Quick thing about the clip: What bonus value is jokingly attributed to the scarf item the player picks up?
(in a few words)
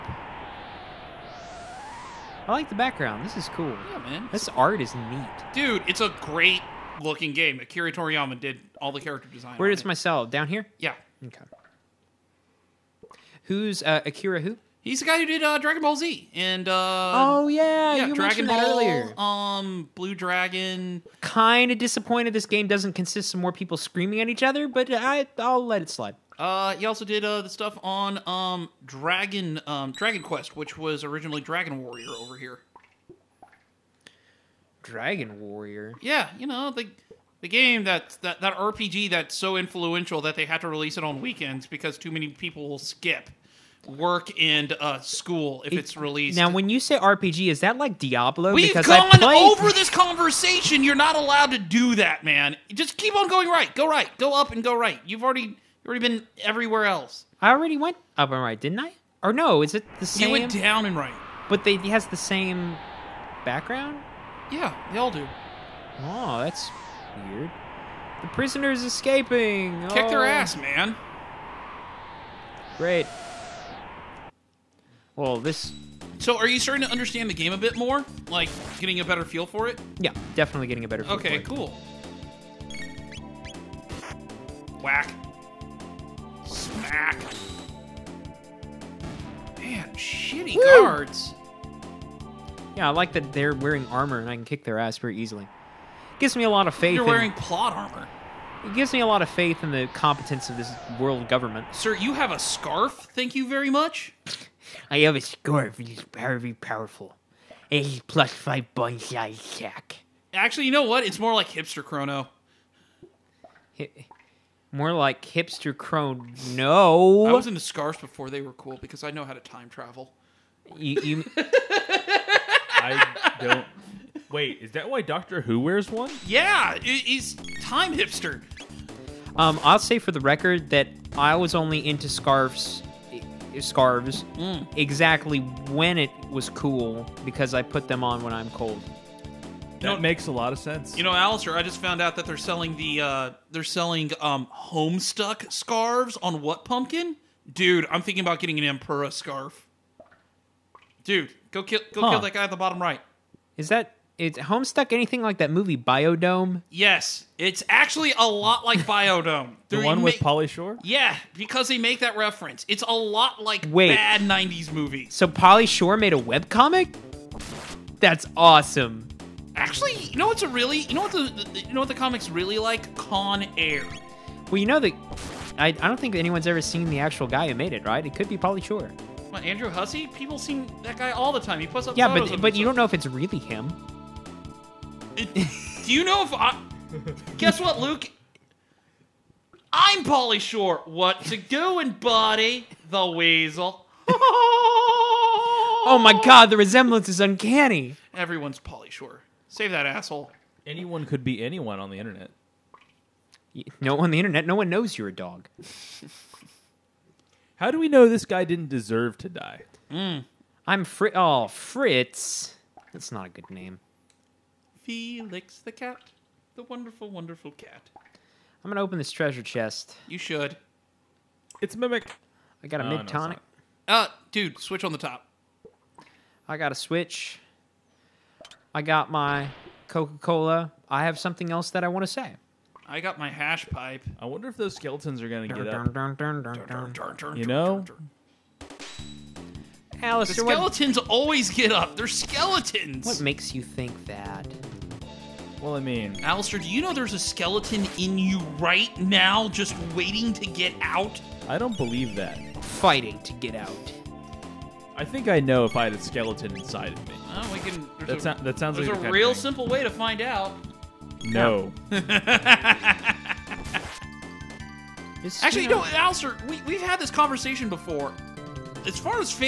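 plus five.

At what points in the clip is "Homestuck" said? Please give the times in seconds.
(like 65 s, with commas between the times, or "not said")
144 s, 154 s.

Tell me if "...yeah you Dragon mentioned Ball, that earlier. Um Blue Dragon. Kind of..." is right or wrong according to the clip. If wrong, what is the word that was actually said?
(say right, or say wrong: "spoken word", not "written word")
right.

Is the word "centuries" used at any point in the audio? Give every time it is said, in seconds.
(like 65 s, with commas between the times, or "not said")
not said.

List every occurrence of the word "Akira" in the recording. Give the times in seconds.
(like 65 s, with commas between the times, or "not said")
7 s, 14 s.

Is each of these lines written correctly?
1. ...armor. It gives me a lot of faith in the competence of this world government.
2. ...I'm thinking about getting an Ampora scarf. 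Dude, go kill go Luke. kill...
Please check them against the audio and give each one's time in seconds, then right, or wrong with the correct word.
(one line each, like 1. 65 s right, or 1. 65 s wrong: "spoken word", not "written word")
1. 97 s right
2. 147 s wrong: "Huh", not "Luke".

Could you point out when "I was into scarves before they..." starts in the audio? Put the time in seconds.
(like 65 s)
117 s.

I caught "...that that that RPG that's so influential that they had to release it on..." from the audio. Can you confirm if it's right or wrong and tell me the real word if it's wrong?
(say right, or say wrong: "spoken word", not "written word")
right.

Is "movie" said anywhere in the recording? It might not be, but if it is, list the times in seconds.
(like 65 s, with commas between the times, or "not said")
155 s, 164 s.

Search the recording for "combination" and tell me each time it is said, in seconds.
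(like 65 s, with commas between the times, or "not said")
not said.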